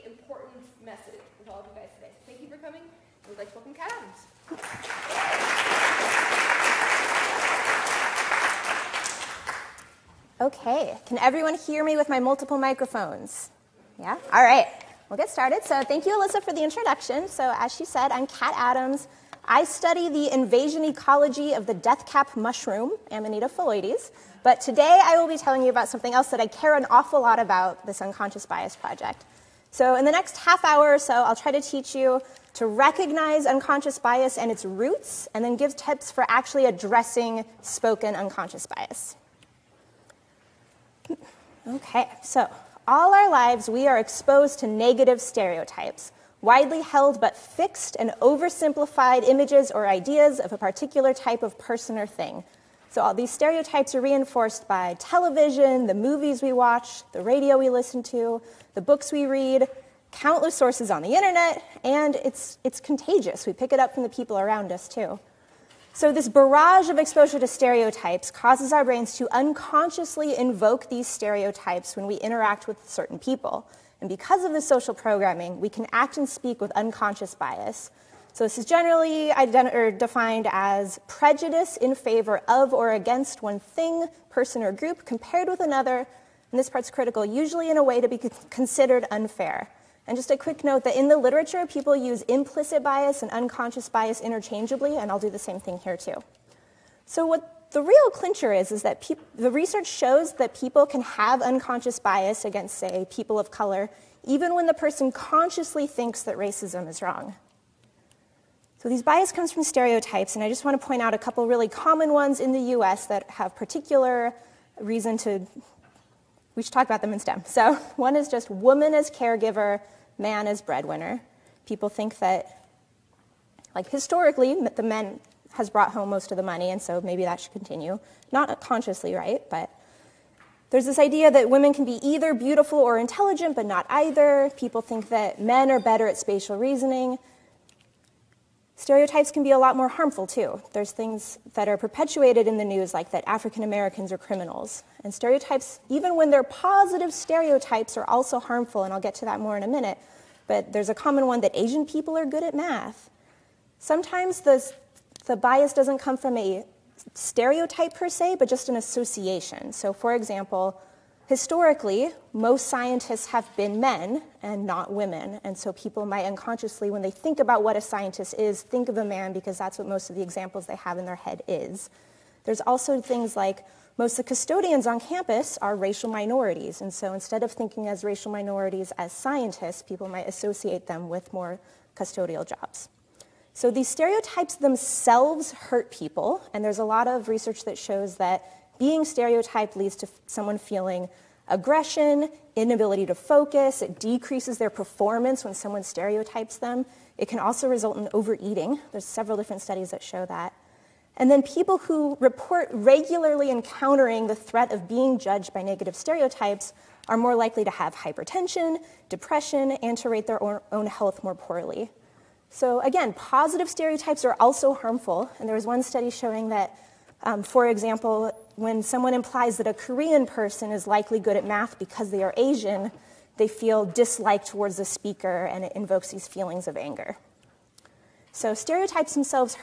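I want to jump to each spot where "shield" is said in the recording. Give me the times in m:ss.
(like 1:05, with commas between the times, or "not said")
not said.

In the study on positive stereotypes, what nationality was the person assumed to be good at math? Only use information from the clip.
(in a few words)
Korean.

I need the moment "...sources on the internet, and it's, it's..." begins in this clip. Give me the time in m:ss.
1:00.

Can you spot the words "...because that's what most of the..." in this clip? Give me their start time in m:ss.
2:49.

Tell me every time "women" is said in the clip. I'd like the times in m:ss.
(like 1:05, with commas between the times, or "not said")
2:11, 2:44.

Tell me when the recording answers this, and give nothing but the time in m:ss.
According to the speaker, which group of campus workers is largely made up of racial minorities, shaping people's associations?
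2:54.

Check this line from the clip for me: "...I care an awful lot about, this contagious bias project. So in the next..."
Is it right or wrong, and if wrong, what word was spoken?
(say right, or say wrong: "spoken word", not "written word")
wrong: "unconscious", not "contagious".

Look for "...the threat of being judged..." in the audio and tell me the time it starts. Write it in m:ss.
3:24.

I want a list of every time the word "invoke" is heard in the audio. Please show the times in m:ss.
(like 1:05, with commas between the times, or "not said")
1:10, 3:45.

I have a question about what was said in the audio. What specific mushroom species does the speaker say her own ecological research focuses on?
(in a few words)
Amanita phalloides.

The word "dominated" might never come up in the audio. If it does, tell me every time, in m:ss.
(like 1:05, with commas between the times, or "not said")
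not said.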